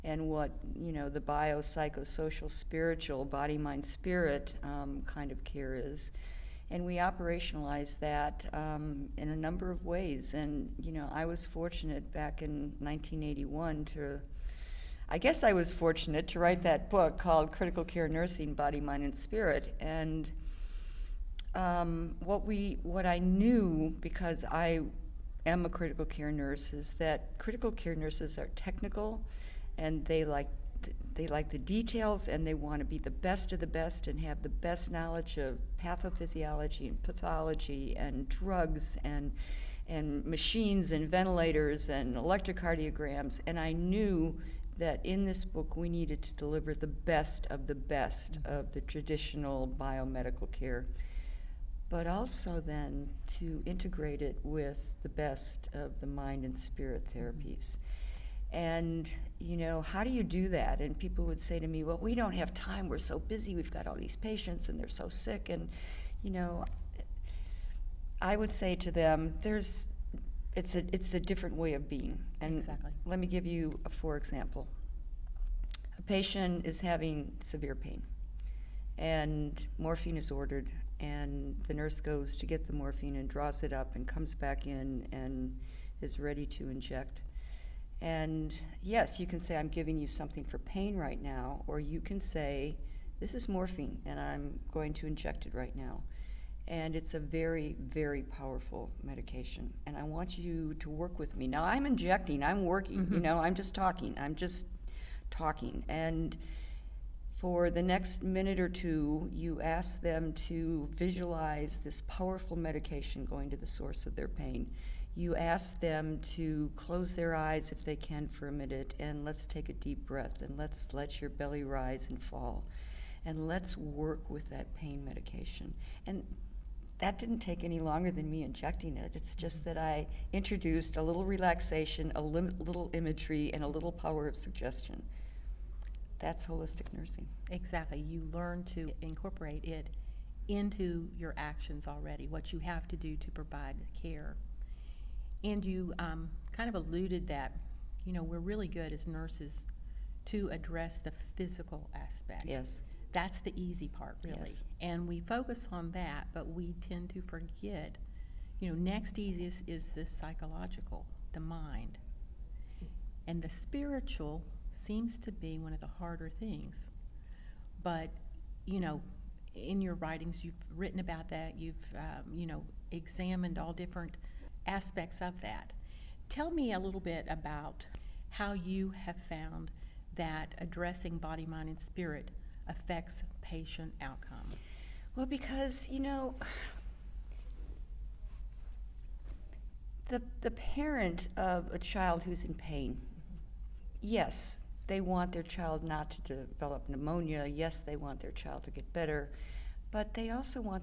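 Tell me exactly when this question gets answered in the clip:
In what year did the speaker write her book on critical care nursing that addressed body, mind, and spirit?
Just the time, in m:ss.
0:12.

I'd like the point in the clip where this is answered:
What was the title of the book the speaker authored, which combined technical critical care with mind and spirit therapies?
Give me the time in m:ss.
0:17.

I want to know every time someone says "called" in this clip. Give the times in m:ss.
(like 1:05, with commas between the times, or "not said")
0:17.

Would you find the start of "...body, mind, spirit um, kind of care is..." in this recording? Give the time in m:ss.
0:03.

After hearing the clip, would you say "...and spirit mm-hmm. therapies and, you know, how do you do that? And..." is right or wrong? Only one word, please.
right.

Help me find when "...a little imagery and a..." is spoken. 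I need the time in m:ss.
2:12.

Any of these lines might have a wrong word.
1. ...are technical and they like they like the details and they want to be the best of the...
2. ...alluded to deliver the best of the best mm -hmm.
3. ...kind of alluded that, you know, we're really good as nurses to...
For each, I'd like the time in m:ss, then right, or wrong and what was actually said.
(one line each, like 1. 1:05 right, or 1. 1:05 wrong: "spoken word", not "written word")
1. 0:28 right
2. 0:45 wrong: "needed", not "alluded"
3. 2:26 right.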